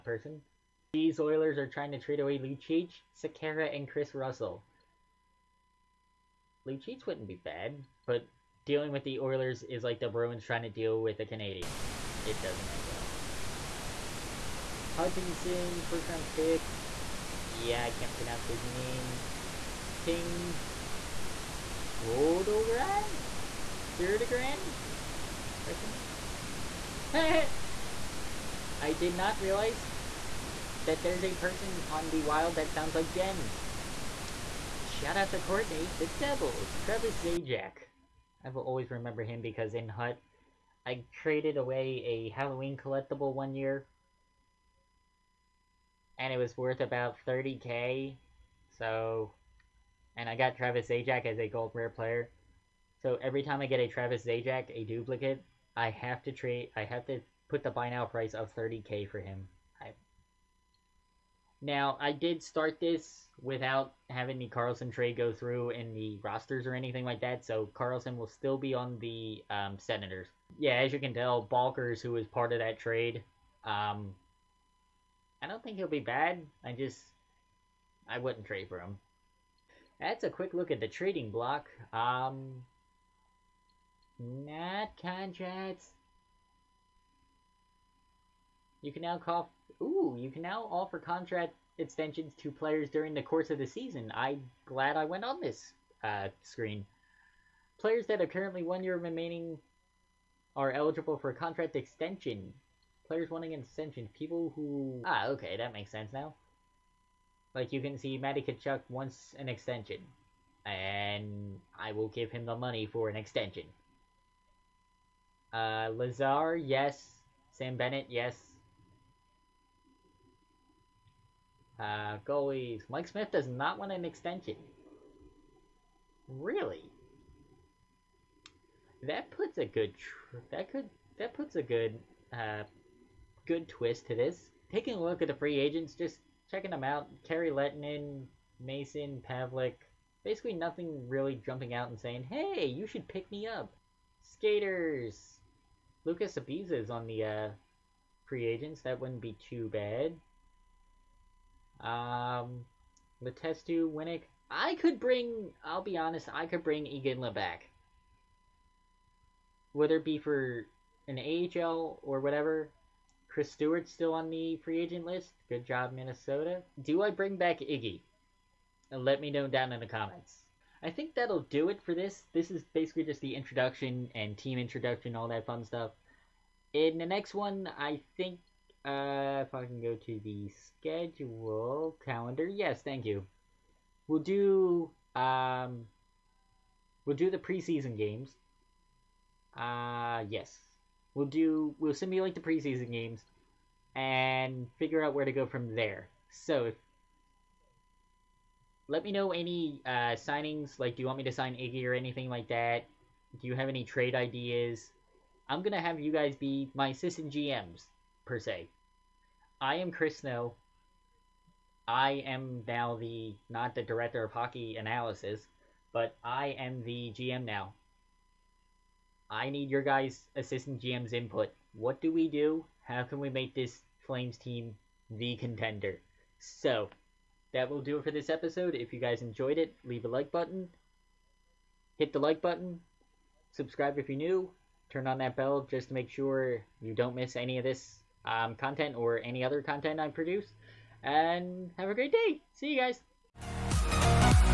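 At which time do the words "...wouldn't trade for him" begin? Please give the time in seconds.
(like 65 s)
78 s.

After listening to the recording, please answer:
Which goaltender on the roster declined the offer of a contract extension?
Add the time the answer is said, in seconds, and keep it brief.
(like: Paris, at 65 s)
Mike Smith, at 122 s.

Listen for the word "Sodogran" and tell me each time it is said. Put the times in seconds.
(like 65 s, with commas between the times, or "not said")
21 s.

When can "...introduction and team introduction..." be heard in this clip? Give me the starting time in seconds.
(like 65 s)
173 s.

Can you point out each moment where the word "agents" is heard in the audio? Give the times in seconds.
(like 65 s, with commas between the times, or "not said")
135 s, 148 s, 164 s.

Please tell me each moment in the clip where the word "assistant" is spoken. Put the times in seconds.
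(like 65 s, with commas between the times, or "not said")
206 s, 220 s.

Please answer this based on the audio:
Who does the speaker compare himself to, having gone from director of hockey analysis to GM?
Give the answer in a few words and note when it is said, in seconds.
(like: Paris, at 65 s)
Chris Snow, at 209 s.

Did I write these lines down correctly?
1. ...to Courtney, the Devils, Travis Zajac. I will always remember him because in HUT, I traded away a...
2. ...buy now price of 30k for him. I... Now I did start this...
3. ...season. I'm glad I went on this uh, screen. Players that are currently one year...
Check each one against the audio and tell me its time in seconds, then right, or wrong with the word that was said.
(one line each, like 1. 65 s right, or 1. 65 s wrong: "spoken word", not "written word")
1. 35 s right
2. 57 s right
3. 93 s right.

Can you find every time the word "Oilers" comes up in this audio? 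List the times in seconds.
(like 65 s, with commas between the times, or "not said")
1 s, 9 s.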